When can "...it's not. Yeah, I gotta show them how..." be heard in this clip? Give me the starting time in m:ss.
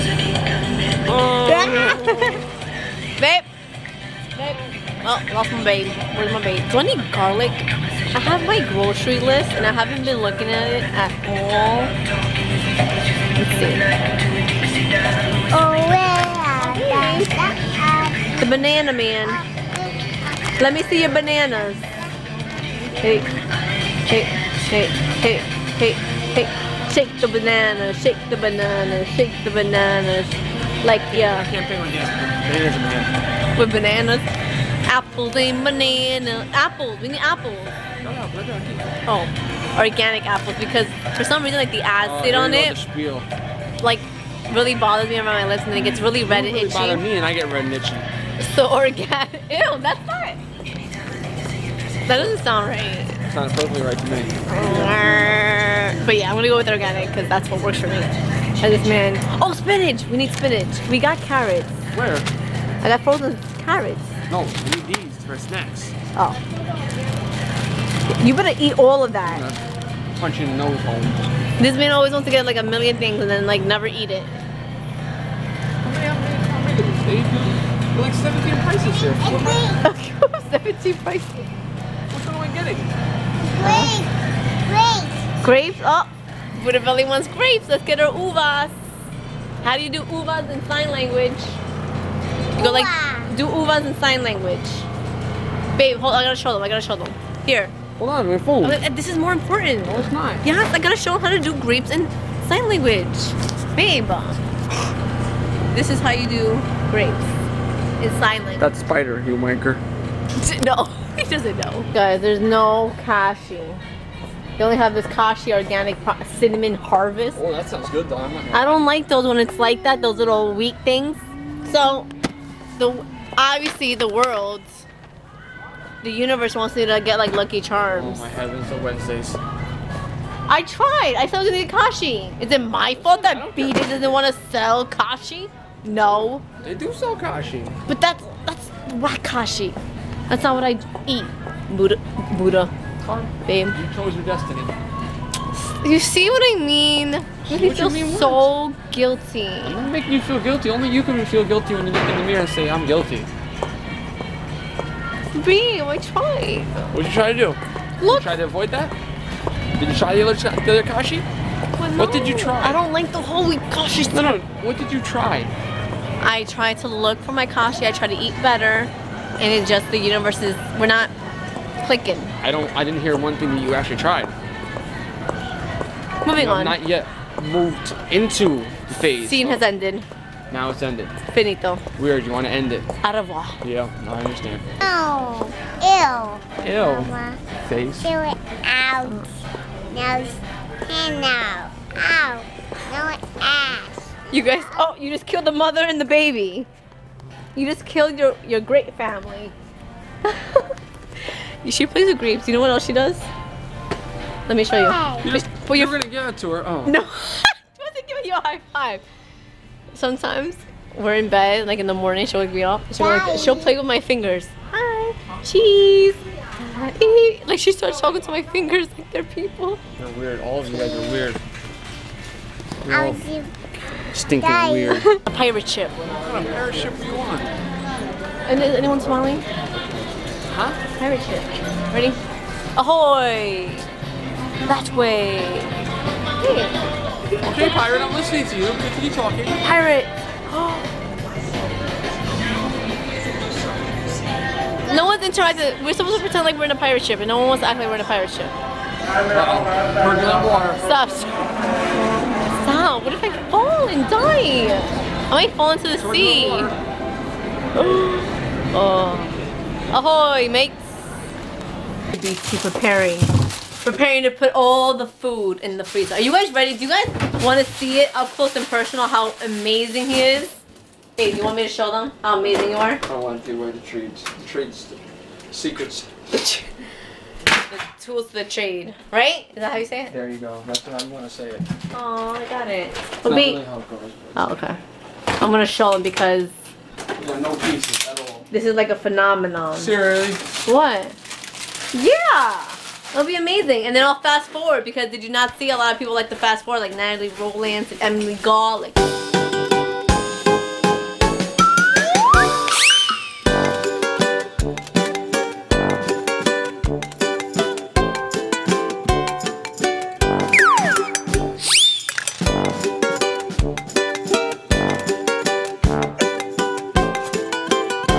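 1:39.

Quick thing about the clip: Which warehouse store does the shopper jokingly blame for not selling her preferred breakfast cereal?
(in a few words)
BJ's.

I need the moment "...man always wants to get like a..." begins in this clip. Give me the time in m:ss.
1:11.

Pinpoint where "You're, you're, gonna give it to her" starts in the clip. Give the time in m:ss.
3:25.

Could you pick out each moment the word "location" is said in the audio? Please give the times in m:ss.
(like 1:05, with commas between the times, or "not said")
not said.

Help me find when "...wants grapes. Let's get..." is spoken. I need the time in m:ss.
1:27.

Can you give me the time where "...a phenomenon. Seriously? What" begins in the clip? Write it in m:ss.
4:48.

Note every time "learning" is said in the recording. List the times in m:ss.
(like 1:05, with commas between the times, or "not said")
not said.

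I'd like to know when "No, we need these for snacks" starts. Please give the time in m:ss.
1:04.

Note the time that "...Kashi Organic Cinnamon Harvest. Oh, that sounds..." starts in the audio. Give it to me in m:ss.
1:55.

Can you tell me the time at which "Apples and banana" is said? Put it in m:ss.
0:34.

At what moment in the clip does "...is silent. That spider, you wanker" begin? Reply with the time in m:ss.
1:48.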